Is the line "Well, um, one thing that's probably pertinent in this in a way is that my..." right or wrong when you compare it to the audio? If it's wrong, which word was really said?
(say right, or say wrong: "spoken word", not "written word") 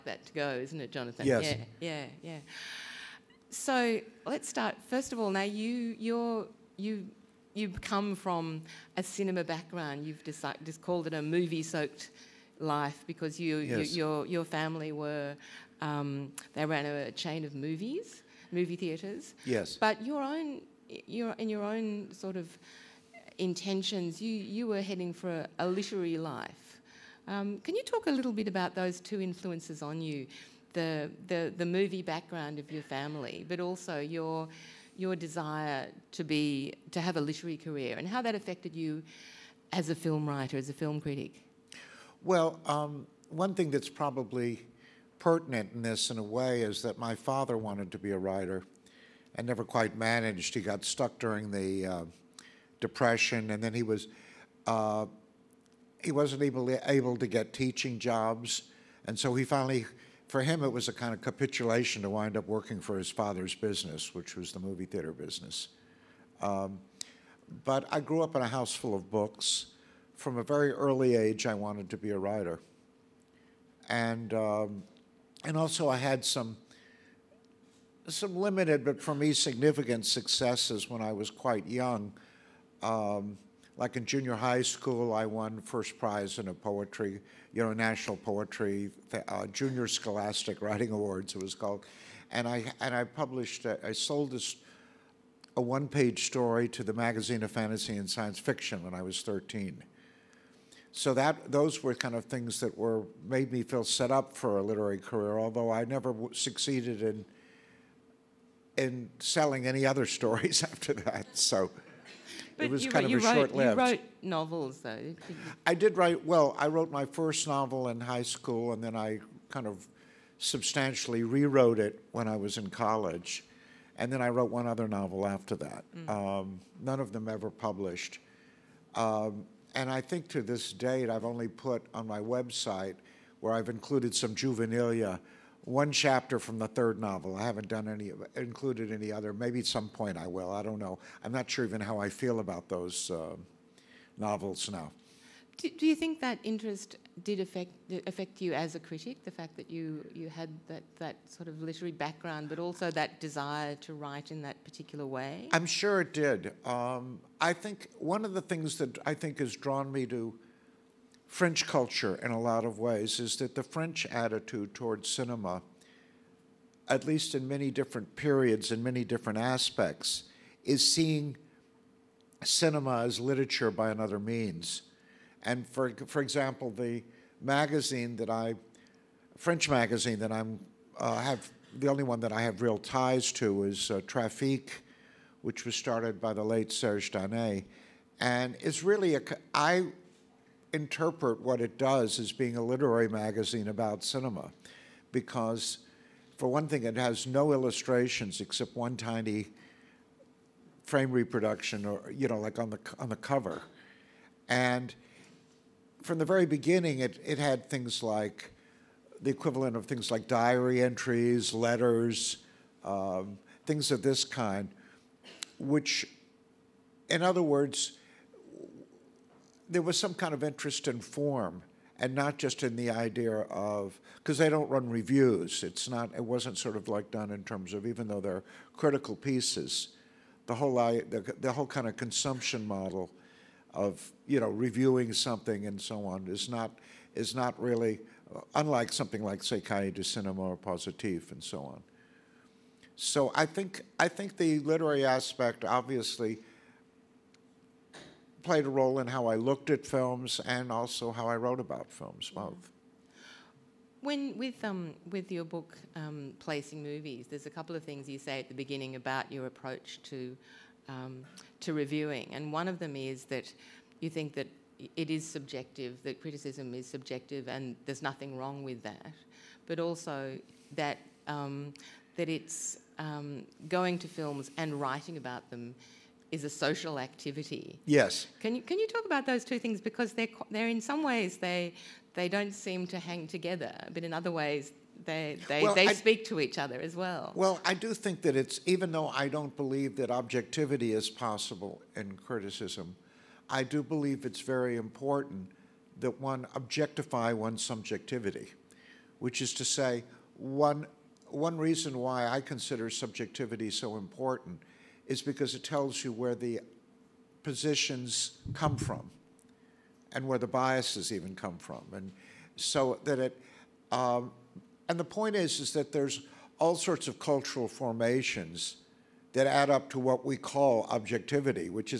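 right.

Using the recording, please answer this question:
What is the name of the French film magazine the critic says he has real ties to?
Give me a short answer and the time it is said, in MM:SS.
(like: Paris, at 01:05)
Trafic, at 03:04.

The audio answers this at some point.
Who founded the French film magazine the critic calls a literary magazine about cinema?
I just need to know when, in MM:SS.
03:06.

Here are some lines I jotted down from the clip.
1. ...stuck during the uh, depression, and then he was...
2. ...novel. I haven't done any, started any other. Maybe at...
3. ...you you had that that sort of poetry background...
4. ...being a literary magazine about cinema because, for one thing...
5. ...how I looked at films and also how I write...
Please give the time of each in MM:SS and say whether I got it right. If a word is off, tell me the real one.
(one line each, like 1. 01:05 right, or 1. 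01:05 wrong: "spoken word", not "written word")
1. 00:50 right
2. 02:16 wrong: "included", not "started"
3. 02:29 wrong: "literary", not "poetry"
4. 03:12 right
5. 04:09 wrong: "wrote", not "write".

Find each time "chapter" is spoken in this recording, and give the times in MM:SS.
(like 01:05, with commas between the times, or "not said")
02:15.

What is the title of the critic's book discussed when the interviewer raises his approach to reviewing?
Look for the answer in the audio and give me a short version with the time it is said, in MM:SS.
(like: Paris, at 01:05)
Placing Movies, at 04:16.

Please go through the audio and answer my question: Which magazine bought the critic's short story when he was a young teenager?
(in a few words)
The Magazine of Fantasy and Science Fiction.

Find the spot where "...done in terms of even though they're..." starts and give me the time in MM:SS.
03:47.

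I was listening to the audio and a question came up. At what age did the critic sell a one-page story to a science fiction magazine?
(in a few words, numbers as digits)
13.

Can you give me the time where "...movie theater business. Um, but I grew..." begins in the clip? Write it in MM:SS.
01:04.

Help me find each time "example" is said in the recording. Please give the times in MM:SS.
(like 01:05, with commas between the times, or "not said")
02:56.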